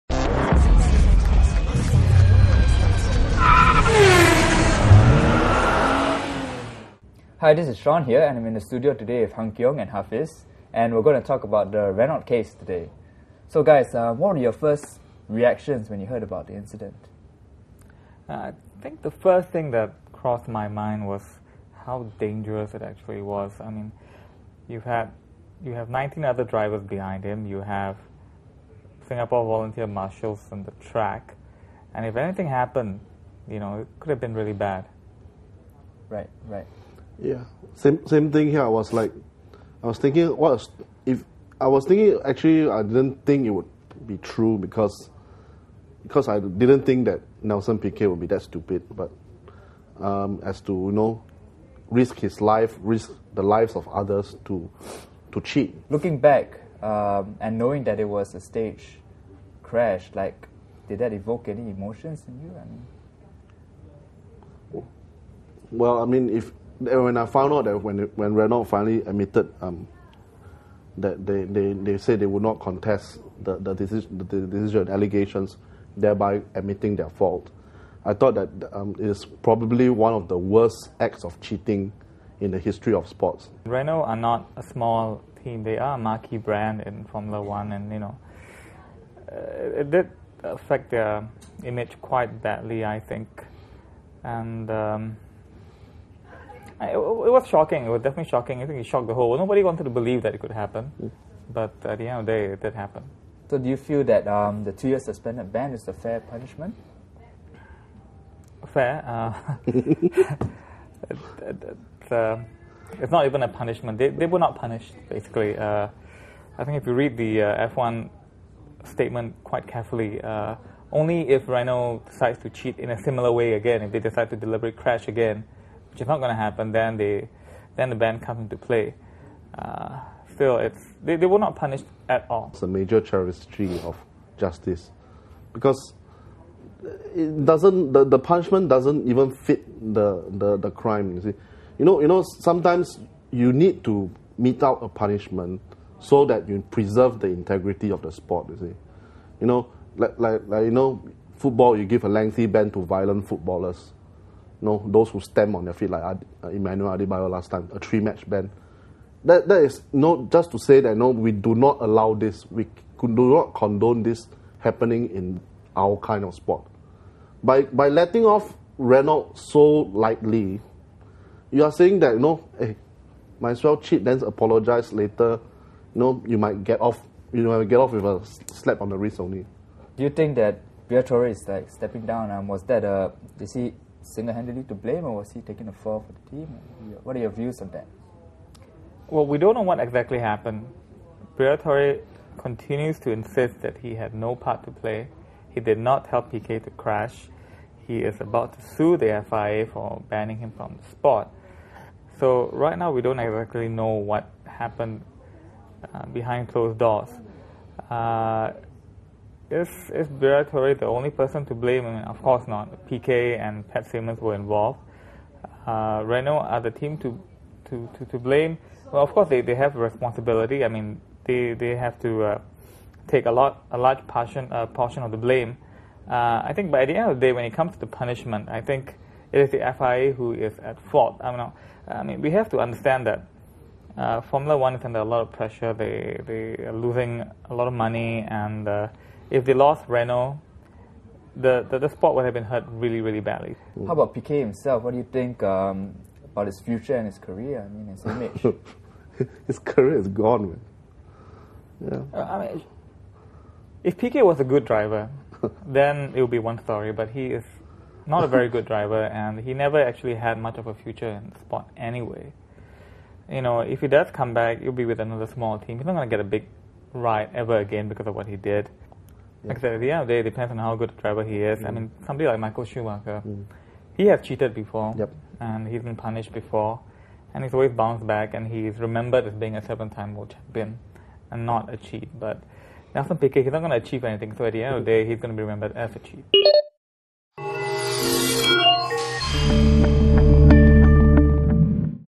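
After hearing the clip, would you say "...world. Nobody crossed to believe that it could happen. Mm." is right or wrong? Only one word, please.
wrong.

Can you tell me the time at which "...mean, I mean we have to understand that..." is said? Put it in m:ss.
3:51.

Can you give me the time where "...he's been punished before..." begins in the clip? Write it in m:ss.
4:35.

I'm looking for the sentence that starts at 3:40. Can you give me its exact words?
I mean, they they have to uh, take a lot a large portion uh, portion of the blame.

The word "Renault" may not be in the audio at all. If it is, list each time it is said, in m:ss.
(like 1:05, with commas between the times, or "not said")
0:11, 1:08, 1:23, 2:01, 2:48, 3:36, 3:59.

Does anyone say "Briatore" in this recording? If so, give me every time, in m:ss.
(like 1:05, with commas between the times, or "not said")
3:00, 3:11, 3:30.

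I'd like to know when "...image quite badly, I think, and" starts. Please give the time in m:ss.
1:31.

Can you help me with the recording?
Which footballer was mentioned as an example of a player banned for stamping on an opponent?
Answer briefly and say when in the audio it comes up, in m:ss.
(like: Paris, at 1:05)
Emmanuel Adebayor, at 2:36.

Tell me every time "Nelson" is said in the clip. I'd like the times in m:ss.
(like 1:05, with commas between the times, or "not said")
0:47, 4:42.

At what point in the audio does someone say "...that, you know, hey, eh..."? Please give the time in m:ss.
2:51.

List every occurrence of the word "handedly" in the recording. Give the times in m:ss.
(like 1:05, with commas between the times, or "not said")
3:04.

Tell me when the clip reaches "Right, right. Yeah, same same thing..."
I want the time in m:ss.
0:36.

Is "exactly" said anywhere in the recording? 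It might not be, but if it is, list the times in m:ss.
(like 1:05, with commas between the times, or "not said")
3:09, 3:23.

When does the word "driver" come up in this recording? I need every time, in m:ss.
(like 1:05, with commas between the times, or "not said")
0:26, 4:14, 4:18, 4:31.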